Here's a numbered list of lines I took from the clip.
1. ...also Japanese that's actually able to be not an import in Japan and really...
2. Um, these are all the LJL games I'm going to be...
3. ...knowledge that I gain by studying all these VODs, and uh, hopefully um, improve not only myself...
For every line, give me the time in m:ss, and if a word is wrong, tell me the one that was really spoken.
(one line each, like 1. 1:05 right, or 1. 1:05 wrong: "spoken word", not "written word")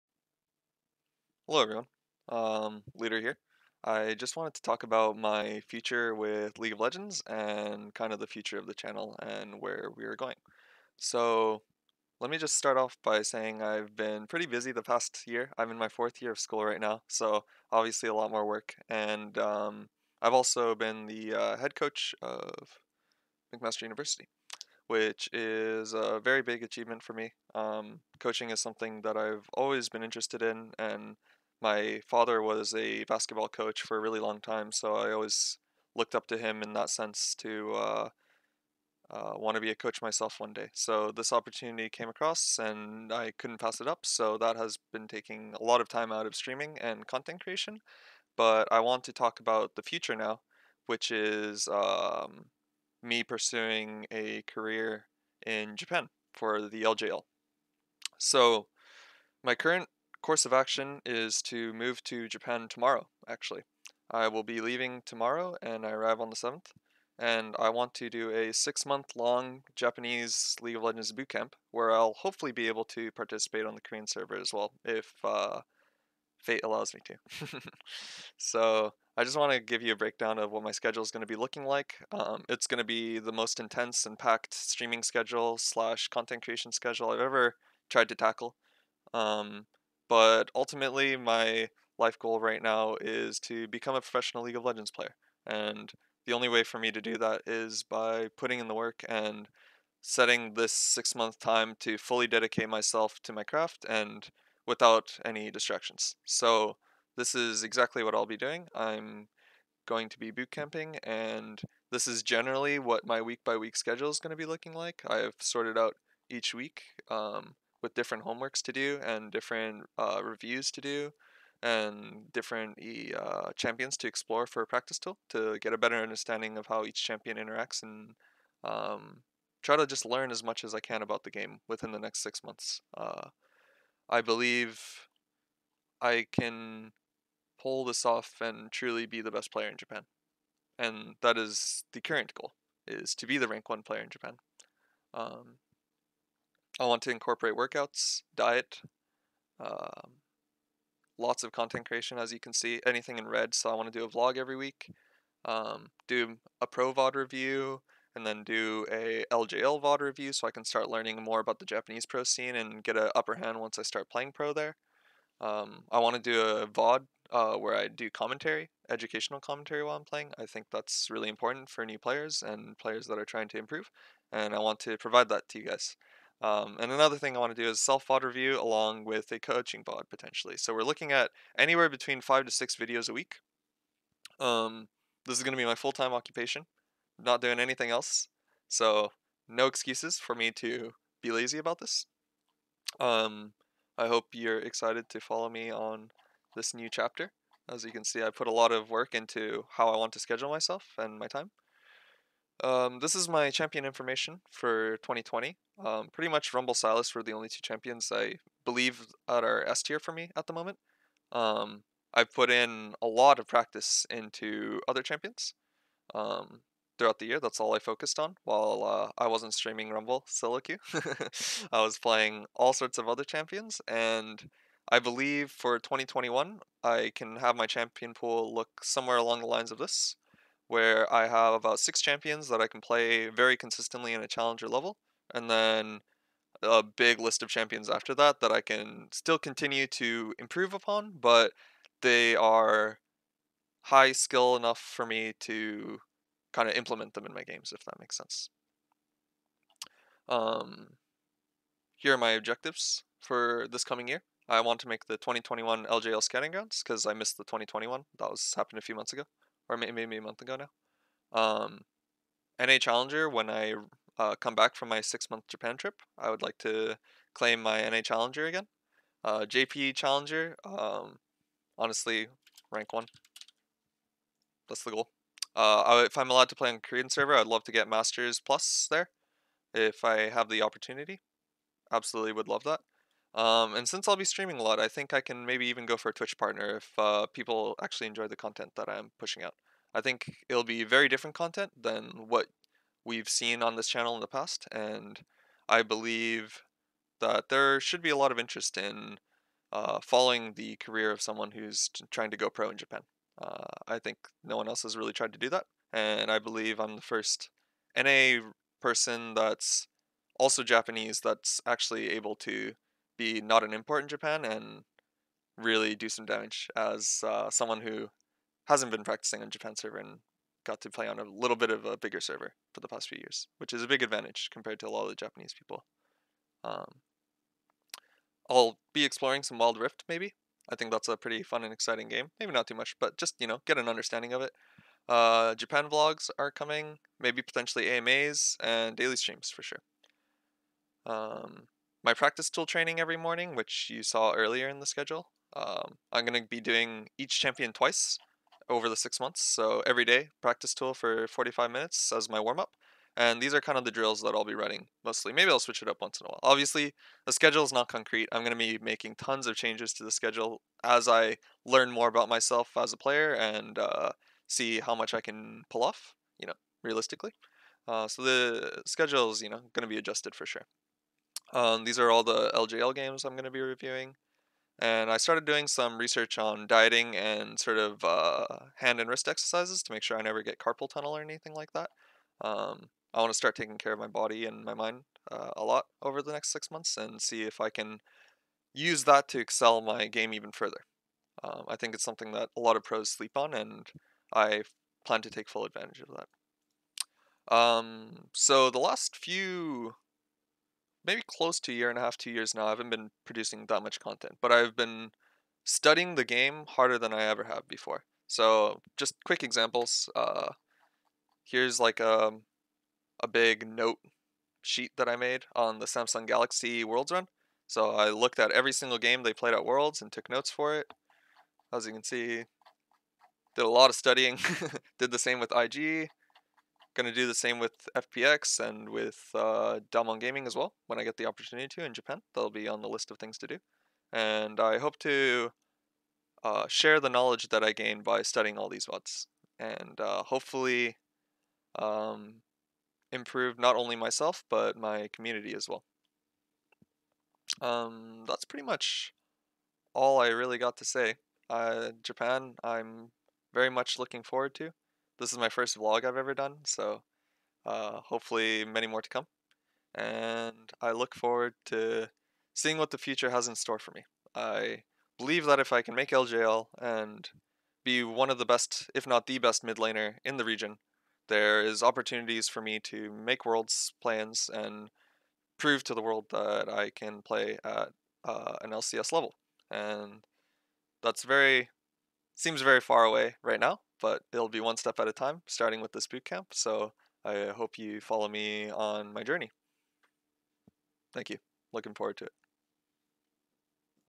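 1. 5:10 right
2. 6:11 right
3. 7:17 right.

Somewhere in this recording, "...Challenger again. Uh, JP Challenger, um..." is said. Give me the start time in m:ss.
4:28.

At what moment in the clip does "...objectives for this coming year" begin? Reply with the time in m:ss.
4:12.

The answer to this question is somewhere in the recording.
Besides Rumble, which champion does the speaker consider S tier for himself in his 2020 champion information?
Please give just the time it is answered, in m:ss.
3:26.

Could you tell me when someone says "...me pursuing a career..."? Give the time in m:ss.
0:53.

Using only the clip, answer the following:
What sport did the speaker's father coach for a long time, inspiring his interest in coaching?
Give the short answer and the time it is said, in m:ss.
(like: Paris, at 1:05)
Basketball, at 0:33.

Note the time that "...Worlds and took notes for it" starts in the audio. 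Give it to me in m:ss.
6:59.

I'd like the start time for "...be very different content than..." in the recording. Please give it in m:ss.
4:50.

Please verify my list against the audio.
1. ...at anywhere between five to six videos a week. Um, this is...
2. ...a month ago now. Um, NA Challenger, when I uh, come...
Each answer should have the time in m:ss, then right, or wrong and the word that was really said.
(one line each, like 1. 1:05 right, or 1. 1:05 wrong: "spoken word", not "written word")
1. 3:01 right
2. 4:20 right.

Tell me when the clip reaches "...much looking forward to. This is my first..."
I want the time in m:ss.
7:33.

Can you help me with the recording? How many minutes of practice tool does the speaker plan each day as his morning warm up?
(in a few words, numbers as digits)
45.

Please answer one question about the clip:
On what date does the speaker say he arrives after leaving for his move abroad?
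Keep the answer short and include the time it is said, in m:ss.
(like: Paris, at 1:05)
The 7th, at 1:06.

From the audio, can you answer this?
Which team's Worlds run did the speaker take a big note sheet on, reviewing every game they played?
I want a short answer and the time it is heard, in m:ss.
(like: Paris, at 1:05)
Samsung Galaxy, at 6:55.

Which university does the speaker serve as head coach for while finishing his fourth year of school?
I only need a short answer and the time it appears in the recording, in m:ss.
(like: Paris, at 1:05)
McMaster University, at 0:23.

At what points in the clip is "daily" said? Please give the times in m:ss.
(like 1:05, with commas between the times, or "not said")
5:38.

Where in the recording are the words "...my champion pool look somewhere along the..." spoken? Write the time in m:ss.
3:47.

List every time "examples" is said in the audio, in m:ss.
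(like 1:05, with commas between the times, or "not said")
6:49.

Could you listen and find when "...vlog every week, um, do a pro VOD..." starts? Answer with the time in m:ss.
2:34.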